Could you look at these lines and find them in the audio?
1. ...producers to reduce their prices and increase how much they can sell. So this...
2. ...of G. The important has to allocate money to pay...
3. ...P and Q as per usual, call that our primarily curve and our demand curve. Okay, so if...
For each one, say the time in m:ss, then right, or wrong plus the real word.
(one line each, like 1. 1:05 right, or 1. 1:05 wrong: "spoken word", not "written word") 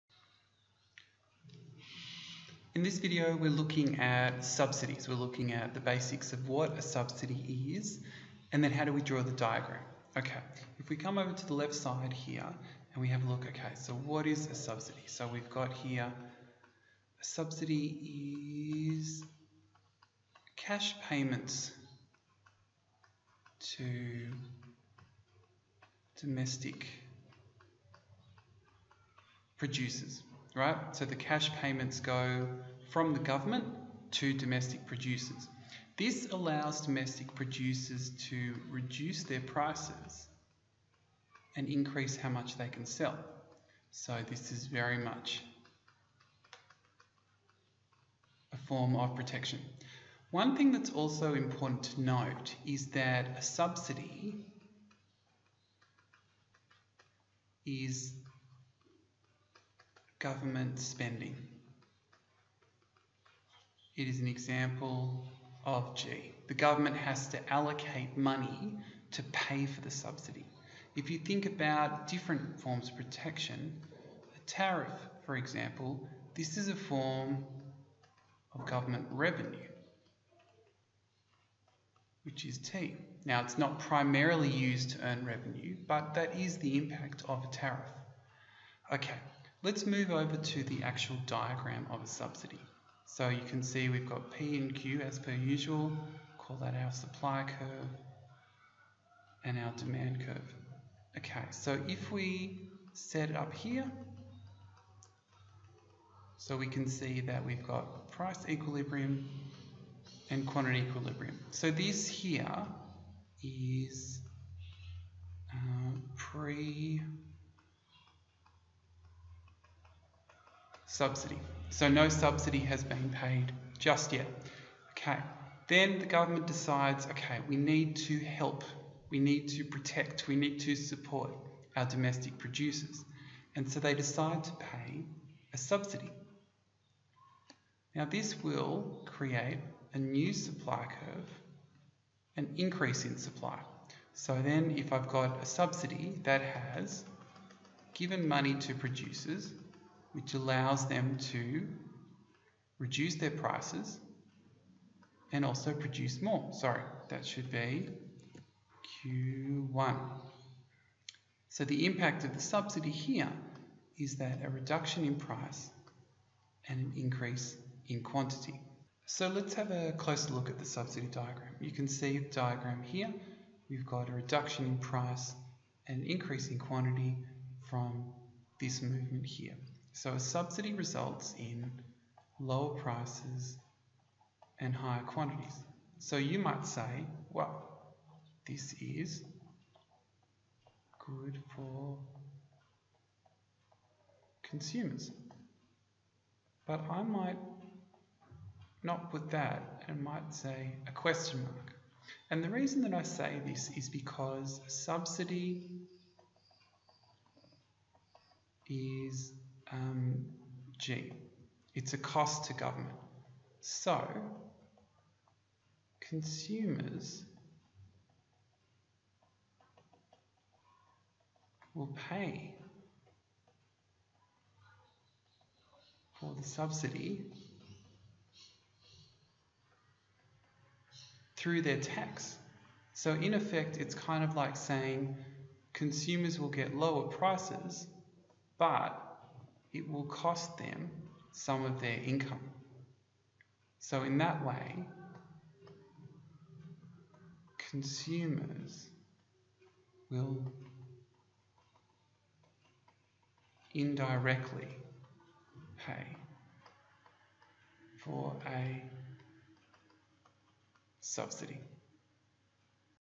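1. 0:37 right
2. 1:05 wrong: "government", not "important"
3. 1:34 wrong: "supply", not "primarily".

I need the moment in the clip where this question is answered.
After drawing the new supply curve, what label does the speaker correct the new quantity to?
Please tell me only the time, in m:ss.
2:39.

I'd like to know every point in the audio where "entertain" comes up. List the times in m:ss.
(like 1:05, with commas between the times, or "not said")
not said.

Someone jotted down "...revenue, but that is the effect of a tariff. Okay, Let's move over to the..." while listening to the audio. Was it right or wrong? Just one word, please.
wrong.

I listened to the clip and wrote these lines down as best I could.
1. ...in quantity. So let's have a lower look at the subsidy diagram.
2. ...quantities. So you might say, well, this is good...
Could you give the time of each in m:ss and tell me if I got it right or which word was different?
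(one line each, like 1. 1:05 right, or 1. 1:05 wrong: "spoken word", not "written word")
1. 2:47 wrong: "closer", not "lower"
2. 3:05 right.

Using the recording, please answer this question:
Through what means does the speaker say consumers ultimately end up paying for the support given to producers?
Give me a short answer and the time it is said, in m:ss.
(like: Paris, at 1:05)
Their tax, at 3:51.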